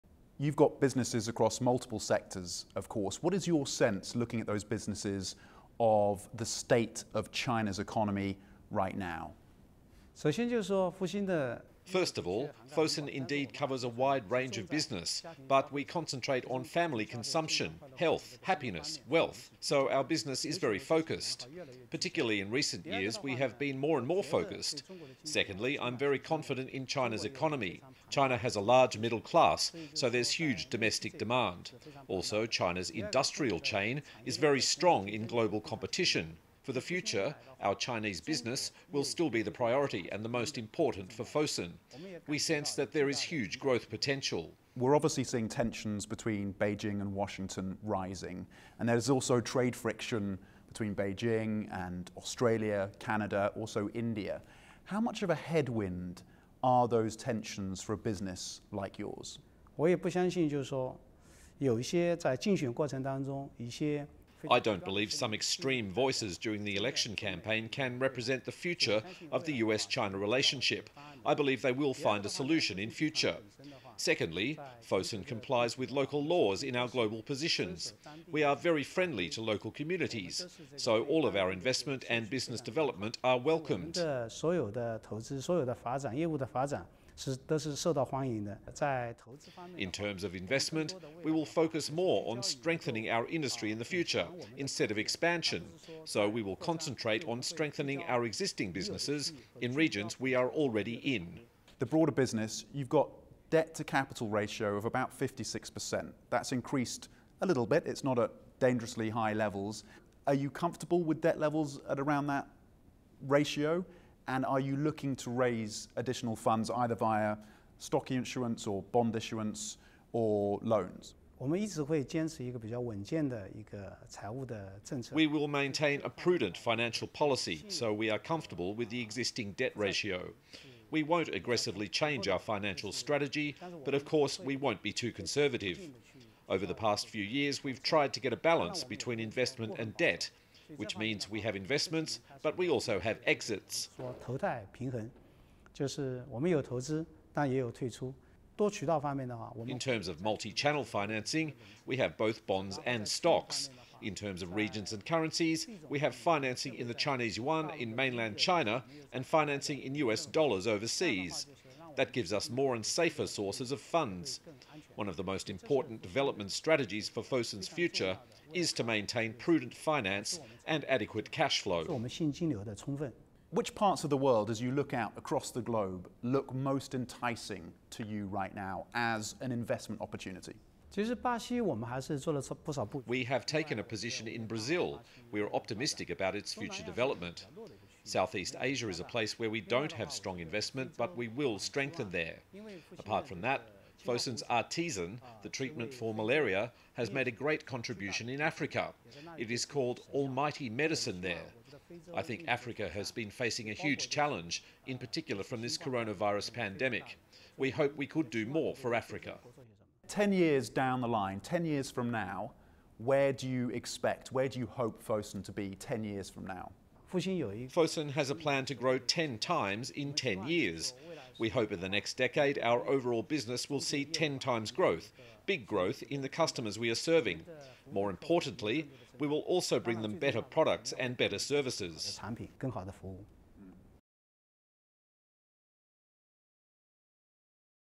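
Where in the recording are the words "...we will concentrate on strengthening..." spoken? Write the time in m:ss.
1:36.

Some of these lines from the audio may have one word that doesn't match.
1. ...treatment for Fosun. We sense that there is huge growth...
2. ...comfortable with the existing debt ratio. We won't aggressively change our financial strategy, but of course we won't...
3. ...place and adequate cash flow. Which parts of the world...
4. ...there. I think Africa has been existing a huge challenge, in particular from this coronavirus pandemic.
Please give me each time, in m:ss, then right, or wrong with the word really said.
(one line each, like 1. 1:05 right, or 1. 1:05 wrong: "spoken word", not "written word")
1. 0:40 wrong: "important", not "treatment"
2. 2:08 right
3. 2:49 wrong: "finance", not "place"
4. 3:21 wrong: "facing", not "existing".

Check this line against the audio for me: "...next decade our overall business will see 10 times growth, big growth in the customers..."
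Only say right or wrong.
right.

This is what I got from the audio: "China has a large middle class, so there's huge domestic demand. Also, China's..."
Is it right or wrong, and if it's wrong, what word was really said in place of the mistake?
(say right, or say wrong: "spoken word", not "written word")
right.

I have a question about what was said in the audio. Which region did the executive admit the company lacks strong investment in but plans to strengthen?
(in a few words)
Southeast Asia.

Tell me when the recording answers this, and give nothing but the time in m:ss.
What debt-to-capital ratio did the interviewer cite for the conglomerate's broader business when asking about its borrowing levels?
1:45.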